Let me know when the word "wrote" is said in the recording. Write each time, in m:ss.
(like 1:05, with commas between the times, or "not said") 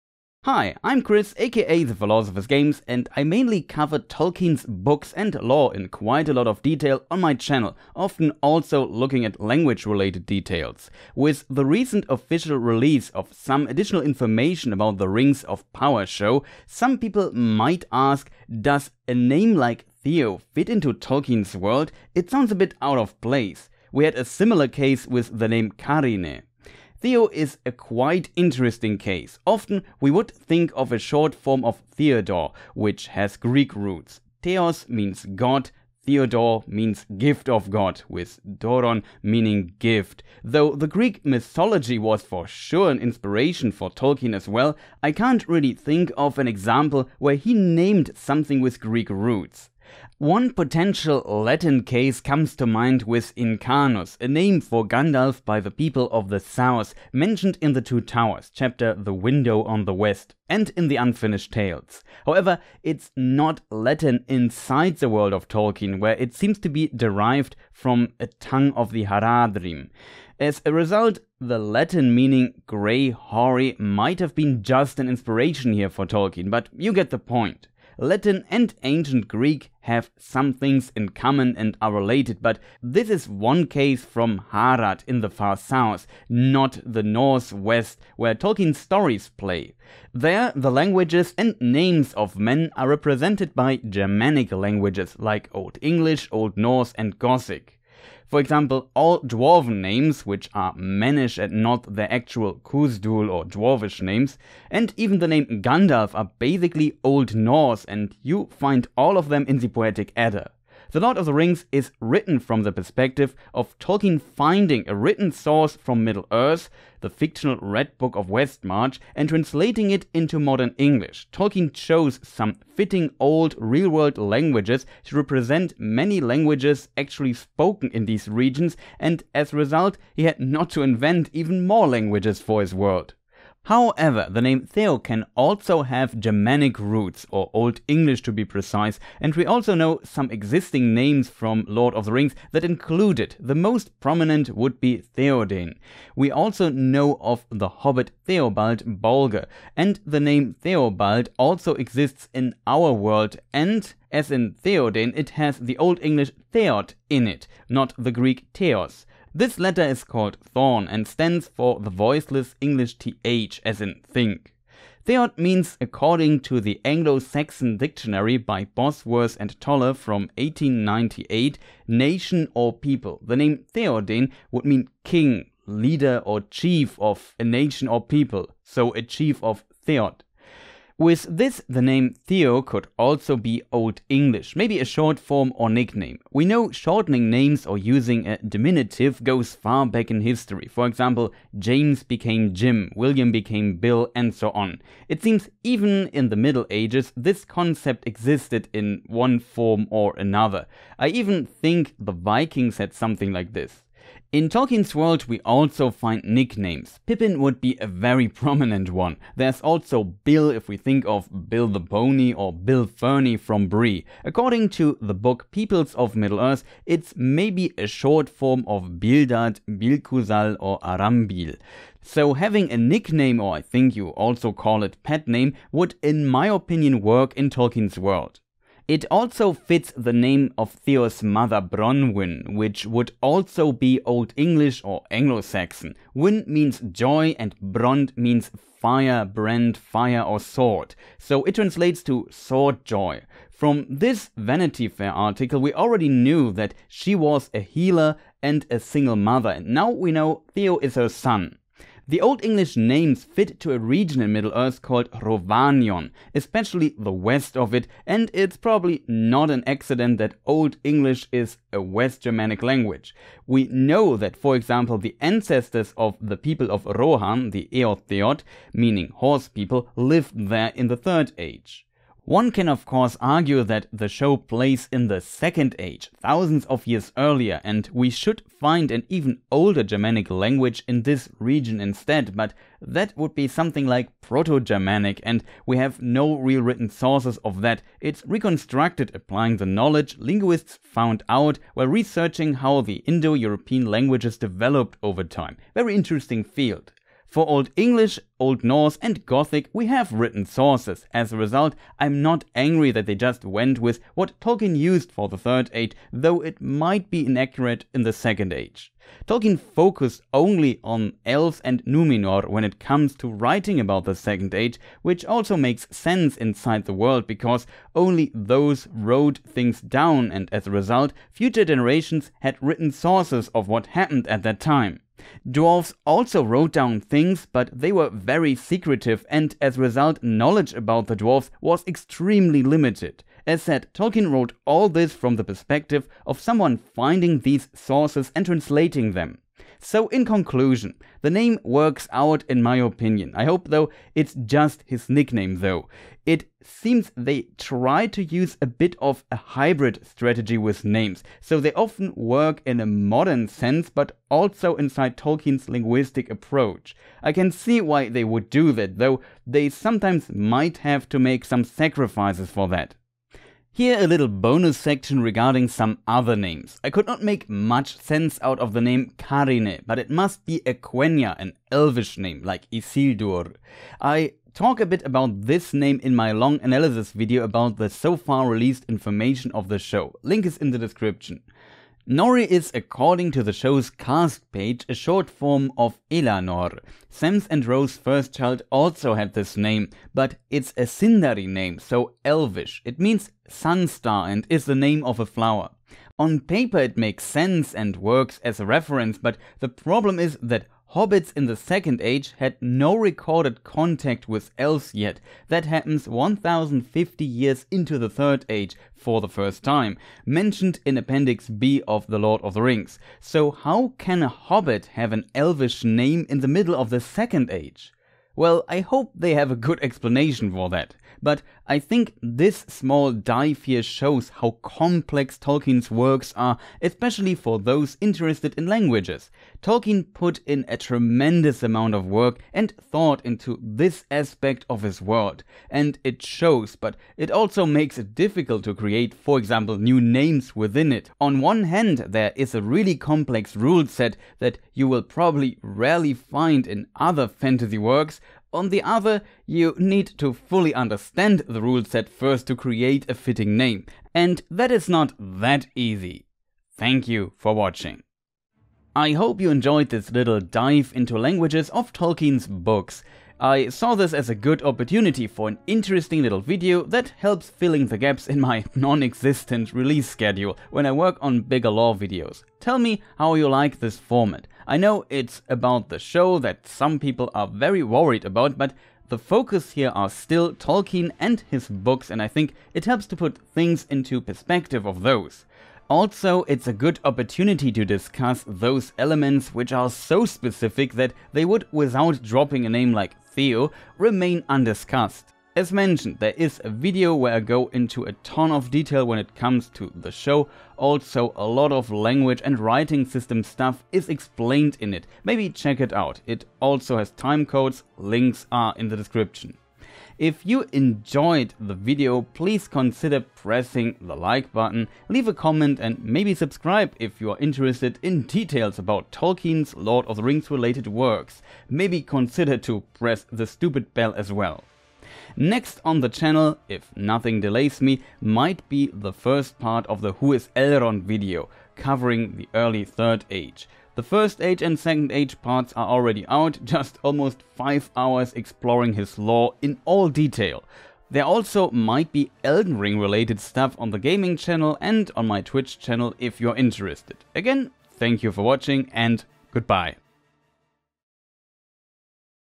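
5:18, 5:26, 5:34.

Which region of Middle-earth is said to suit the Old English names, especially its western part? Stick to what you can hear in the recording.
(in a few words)
Rhovanion.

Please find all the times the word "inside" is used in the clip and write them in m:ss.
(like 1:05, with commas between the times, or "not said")
1:04, 5:16, 5:54.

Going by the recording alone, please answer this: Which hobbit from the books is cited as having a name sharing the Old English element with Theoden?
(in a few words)
Theobald Bolger.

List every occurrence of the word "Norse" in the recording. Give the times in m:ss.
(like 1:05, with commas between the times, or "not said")
1:36, 1:47, 4:58.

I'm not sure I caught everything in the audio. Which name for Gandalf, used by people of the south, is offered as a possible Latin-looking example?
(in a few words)
Incanus.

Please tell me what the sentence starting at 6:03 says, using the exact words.
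Here a little bonus section regarding some other names.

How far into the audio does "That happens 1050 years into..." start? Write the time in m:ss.
6:45.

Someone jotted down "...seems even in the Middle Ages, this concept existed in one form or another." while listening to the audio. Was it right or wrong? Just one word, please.
right.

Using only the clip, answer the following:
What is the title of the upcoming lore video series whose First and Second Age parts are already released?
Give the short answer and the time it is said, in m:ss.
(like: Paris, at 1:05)
Who is Elrond, at 8:50.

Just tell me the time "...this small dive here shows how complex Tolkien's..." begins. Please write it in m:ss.
7:02.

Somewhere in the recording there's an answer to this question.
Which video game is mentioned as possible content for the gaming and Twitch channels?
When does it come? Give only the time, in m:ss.
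9:02.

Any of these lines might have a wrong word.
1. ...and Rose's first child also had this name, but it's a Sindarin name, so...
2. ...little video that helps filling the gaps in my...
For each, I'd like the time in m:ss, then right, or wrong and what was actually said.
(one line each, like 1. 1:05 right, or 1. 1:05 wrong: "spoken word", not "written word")
1. 6:27 right
2. 7:46 right.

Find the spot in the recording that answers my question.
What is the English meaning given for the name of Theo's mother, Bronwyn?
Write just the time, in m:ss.
4:02.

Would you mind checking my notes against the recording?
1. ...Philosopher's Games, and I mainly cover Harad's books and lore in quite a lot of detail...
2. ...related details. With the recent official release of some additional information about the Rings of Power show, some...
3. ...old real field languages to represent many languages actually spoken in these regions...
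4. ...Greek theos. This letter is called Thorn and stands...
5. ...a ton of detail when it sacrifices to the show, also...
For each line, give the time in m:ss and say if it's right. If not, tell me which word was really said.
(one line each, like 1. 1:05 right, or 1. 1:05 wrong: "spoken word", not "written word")
1. 0:01 wrong: "Tolkien", not "Harad"
2. 0:09 right
3. 2:03 wrong: "world", not "field"
4. 2:38 right
5. 8:18 wrong: "comes", not "sacrifices".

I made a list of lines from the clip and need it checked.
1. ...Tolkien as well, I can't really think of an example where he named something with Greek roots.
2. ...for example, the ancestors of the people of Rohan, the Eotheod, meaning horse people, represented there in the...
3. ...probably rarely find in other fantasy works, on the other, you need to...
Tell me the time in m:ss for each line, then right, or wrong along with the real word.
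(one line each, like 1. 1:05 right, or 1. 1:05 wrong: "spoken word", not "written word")
1. 0:43 right
2. 4:24 wrong: "lived", not "represented"
3. 7:25 right.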